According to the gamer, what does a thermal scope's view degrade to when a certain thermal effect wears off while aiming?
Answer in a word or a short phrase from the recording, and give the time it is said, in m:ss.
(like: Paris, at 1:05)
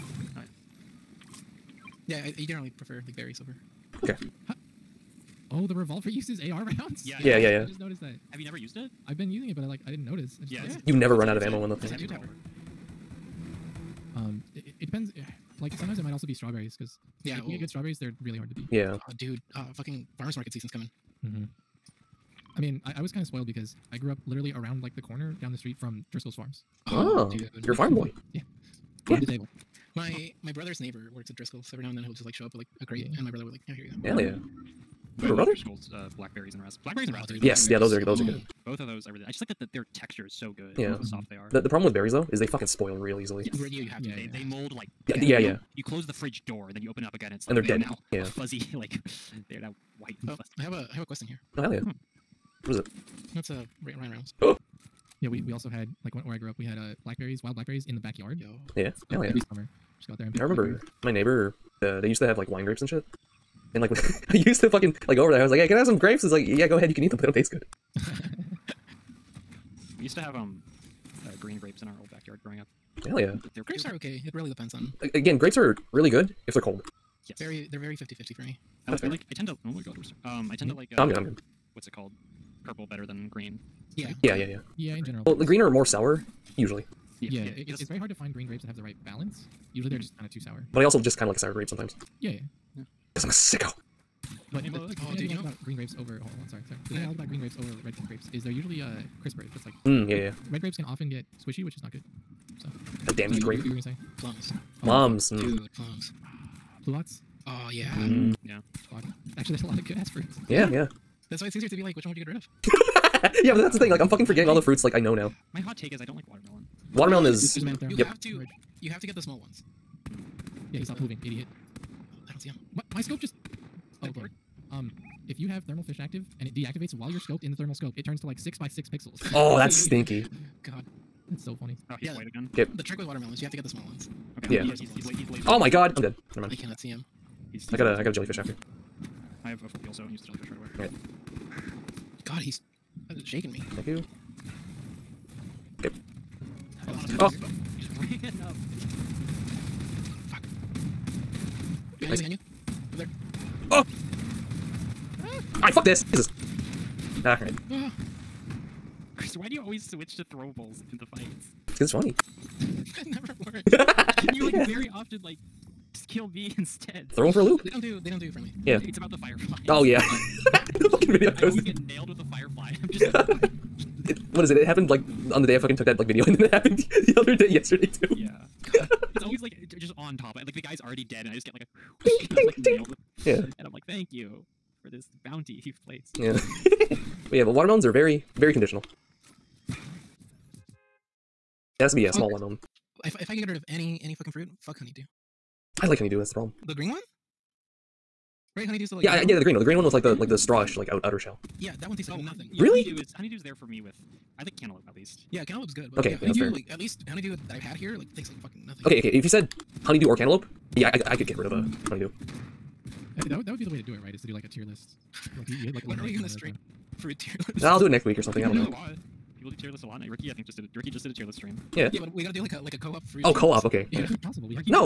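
Six by six pixels, at 2:08.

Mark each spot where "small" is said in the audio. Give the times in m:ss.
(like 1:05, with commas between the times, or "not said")
1:59, 2:13, 3:12.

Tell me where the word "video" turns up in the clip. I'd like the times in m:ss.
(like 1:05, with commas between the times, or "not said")
2:51, 2:56.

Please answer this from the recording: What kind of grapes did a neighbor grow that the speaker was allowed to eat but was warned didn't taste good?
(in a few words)
Wine grapes.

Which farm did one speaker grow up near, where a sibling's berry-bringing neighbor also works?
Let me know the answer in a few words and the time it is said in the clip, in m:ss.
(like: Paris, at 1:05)
Driscoll's Farms, at 0:26.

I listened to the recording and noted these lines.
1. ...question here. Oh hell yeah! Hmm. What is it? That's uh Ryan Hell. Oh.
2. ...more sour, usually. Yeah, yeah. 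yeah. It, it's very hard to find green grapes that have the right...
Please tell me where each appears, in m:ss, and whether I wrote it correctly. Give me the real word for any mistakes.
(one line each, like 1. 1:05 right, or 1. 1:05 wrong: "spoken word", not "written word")
1. 0:51 wrong: "Reynolds", not "Hell"
2. 1:25 right.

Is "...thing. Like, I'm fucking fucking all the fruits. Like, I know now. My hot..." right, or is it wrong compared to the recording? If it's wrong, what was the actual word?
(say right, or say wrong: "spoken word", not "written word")
wrong: "forgetting", not "fucking".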